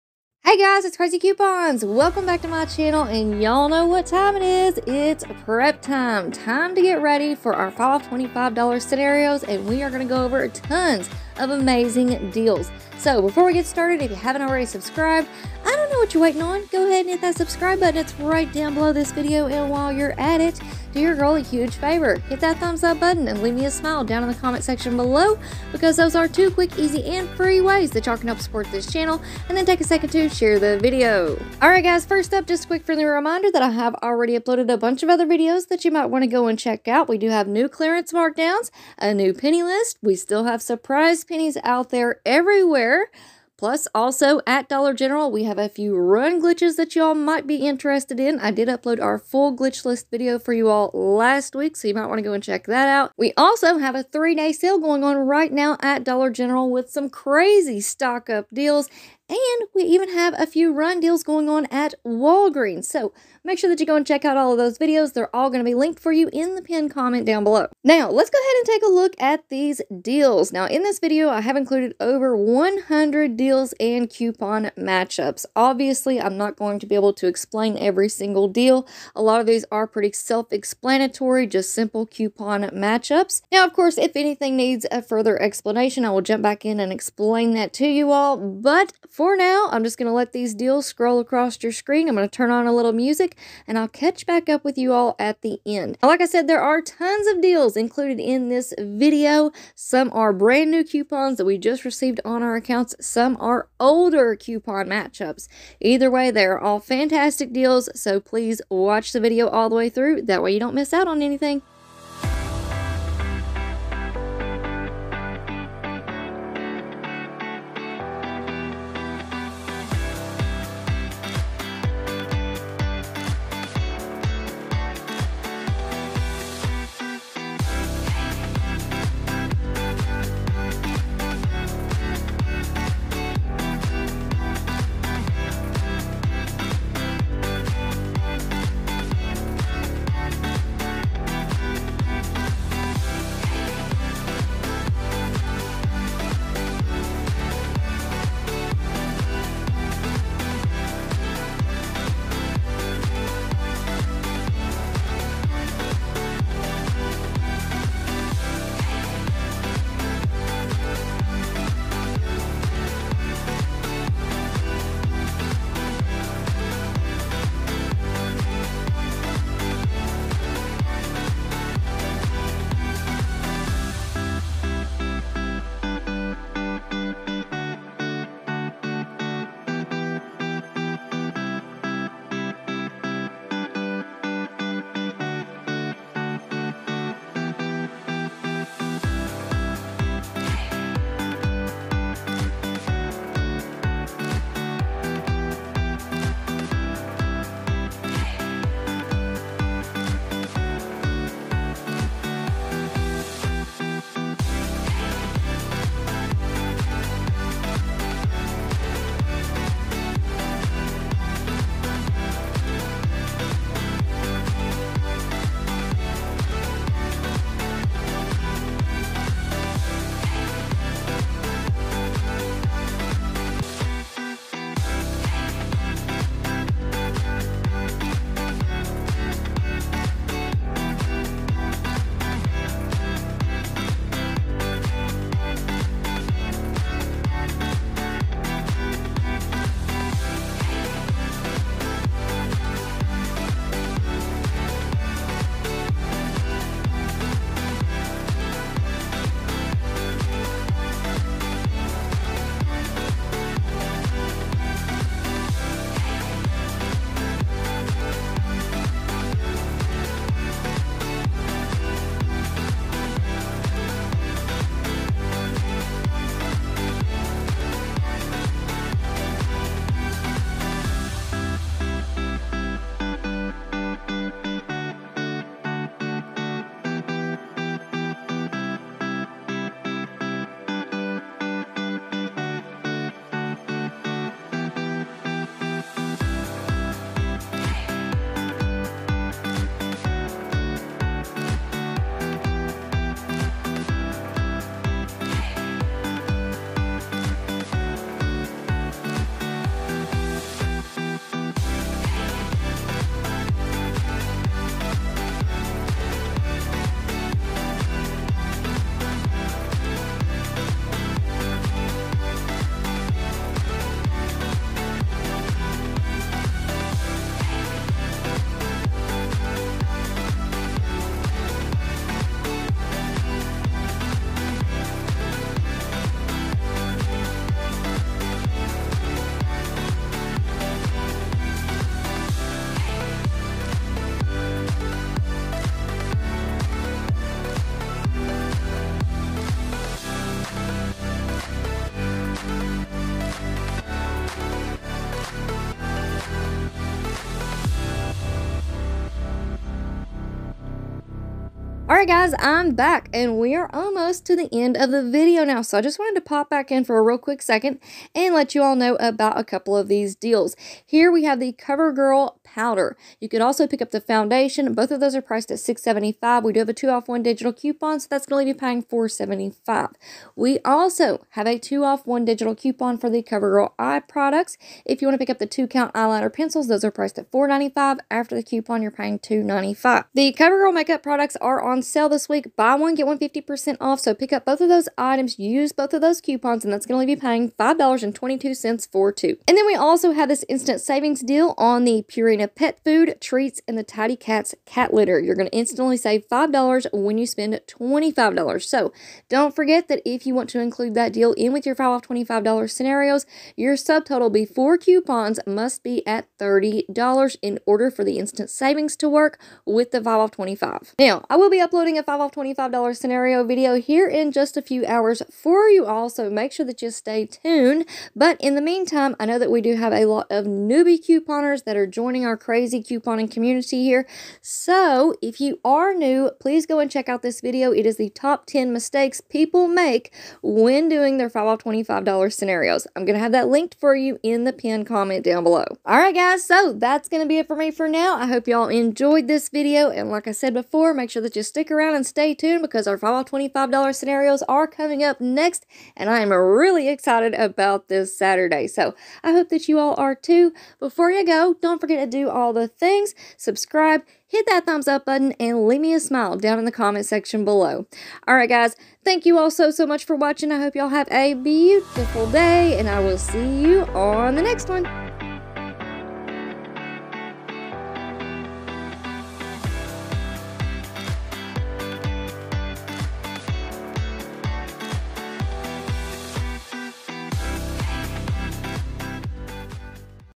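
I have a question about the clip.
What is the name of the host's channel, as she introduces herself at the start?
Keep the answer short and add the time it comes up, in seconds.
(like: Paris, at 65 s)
Craz-E Coupons, at 0 s.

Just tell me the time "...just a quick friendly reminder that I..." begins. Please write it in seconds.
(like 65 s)
32 s.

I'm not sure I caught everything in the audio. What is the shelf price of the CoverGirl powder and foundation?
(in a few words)
$6.75.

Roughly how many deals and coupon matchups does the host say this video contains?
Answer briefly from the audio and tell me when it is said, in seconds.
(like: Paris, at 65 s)
over 100, at 72 s.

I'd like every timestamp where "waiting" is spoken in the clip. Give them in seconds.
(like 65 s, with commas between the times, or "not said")
16 s.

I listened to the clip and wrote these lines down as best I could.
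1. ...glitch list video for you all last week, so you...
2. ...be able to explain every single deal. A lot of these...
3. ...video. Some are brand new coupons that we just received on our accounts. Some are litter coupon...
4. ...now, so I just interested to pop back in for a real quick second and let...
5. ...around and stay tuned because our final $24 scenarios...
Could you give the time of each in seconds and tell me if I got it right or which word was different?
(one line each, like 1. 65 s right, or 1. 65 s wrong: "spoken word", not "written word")
1. 49 s right
2. 76 s right
3. 98 s wrong: "older", not "litter"
4. 355 s wrong: "wanted", not "interested"
5. 441 s wrong: "25", not "24".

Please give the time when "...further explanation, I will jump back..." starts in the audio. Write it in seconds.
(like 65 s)
85 s.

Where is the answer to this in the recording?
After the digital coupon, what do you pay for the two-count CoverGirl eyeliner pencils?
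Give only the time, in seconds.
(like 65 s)
379 s.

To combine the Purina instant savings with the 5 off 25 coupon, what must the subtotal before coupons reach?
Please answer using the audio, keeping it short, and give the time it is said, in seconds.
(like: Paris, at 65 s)
$30, at 406 s.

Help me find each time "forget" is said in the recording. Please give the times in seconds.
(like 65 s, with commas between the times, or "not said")
399 s, 451 s.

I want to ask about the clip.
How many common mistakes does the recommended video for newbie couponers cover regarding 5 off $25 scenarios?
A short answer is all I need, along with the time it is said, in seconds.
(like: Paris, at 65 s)
10, at 428 s.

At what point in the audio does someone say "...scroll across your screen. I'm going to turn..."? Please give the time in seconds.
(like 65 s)
90 s.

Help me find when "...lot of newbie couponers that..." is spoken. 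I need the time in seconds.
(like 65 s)
420 s.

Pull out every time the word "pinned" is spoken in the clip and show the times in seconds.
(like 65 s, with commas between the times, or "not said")
66 s, 434 s.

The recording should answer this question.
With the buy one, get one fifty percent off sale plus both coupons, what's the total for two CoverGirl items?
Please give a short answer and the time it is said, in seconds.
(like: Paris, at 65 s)
$5.22, at 387 s.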